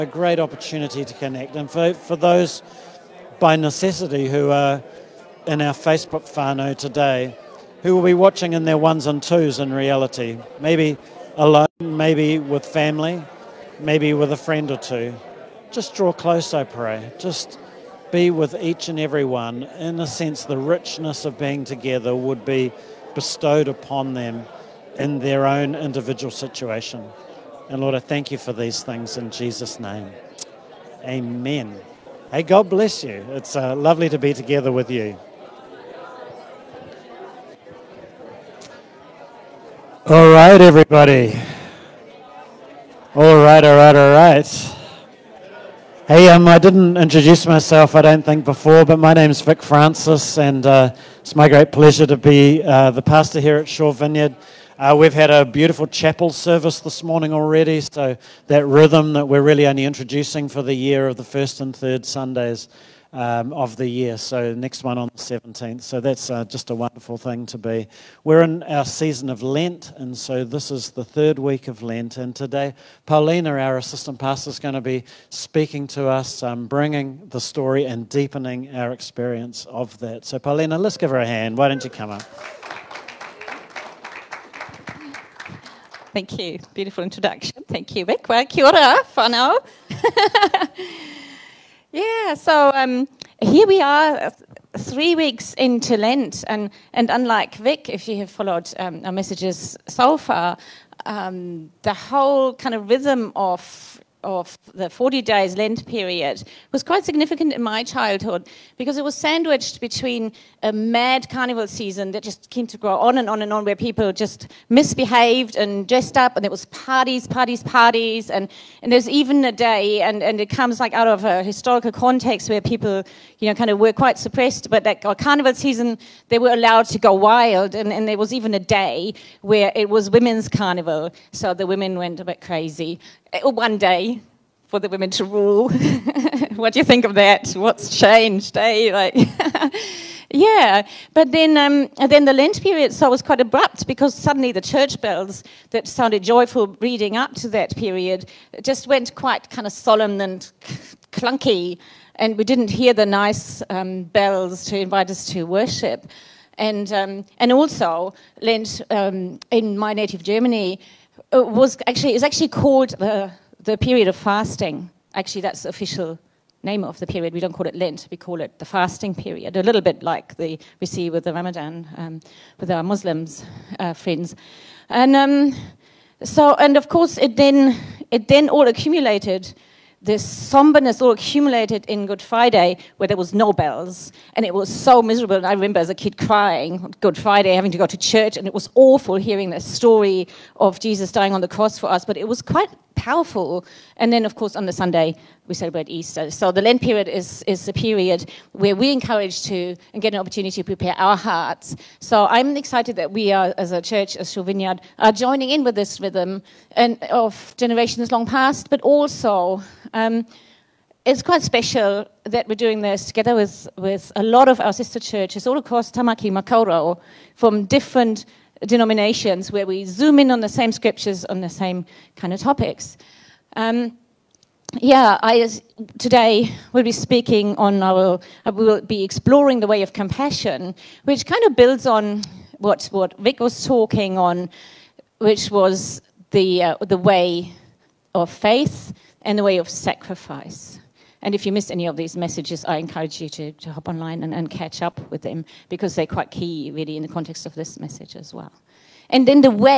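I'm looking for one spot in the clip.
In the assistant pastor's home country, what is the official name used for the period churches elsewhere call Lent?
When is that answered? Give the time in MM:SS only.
02:48.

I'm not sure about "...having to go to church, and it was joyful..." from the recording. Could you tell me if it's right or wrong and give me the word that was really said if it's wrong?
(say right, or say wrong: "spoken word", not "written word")
wrong: "awful", not "joyful".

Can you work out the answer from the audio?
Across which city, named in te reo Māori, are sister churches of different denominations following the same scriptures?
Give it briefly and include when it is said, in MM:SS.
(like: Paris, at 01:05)
Tamaki Makaurau, at 03:35.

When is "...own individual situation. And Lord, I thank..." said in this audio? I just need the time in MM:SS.
00:25.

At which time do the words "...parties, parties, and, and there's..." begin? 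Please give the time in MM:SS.
01:57.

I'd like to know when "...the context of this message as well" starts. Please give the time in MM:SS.
04:07.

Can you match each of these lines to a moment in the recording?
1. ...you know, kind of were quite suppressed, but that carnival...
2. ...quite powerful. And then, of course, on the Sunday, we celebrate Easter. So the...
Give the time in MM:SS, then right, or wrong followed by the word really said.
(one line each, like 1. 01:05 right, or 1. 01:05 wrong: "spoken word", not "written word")
1. 02:03 right
2. 03:12 right.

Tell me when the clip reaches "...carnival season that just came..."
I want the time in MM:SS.
01:51.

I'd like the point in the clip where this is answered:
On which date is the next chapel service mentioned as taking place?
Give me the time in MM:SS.
01:05.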